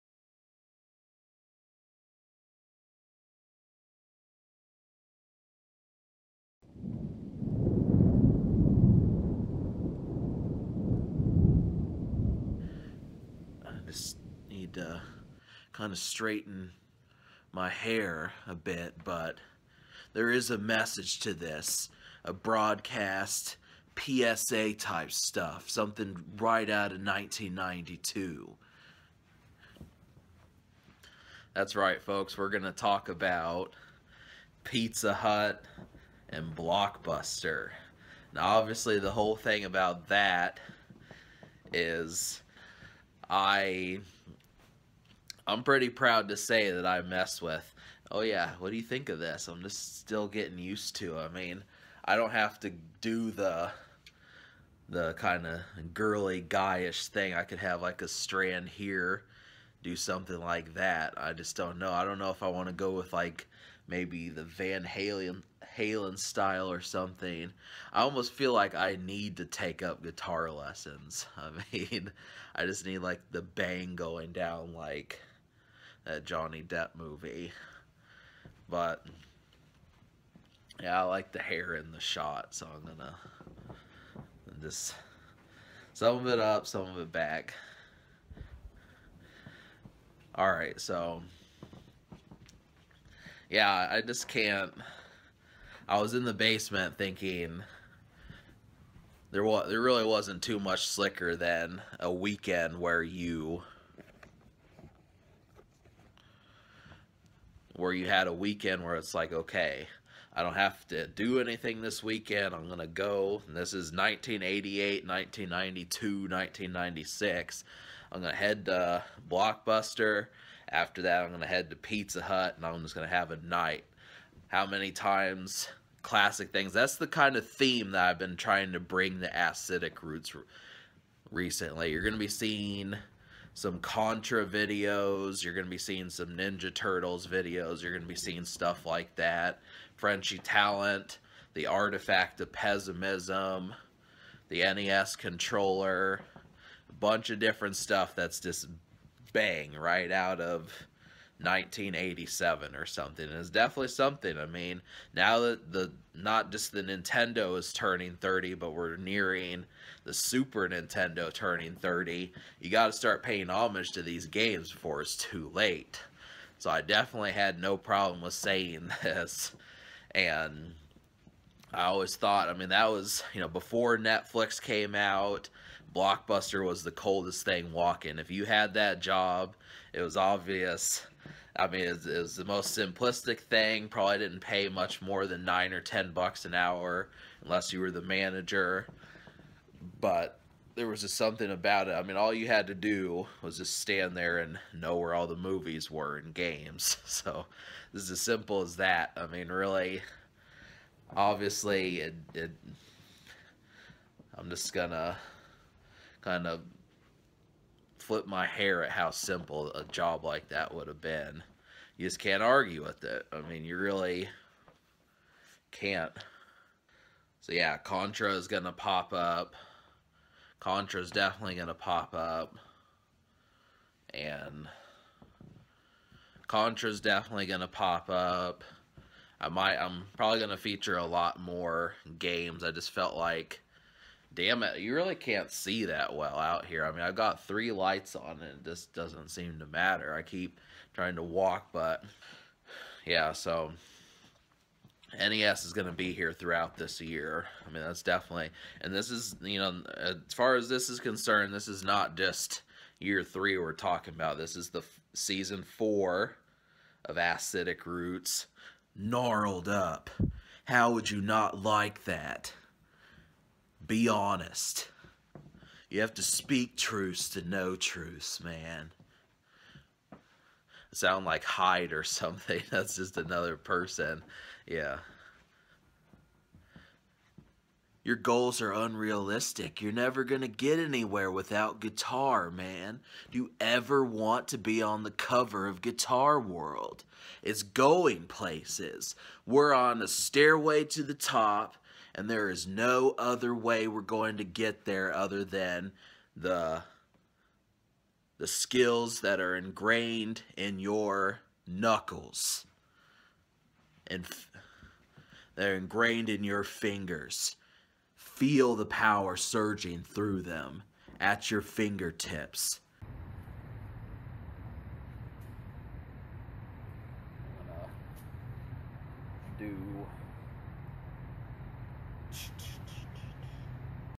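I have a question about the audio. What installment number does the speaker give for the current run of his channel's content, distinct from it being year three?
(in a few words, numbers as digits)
season 4.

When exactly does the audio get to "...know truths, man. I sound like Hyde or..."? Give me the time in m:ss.
4:27.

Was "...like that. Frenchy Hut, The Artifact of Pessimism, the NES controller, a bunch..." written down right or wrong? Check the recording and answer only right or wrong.
wrong.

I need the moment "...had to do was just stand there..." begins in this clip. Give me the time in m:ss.
3:12.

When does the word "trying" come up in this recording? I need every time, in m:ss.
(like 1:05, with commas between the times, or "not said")
2:08, 4:00.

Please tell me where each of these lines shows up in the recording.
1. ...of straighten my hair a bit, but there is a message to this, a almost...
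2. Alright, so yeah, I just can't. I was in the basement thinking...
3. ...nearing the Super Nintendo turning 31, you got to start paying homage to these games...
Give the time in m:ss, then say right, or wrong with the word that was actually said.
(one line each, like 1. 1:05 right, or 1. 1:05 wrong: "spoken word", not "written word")
1. 0:15 wrong: "broadcast", not "almost"
2. 1:30 right
3. 2:38 wrong: "30", not "31".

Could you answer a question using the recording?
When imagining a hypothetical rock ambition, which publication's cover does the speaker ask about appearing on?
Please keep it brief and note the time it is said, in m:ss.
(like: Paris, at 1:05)
Guitar World, at 4:45.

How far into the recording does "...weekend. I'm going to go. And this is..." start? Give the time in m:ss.
1:52.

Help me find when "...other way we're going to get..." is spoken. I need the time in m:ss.
4:53.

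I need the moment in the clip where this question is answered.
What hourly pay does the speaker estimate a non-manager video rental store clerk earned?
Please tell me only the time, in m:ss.
3:05.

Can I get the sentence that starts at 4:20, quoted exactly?
How would you not like that?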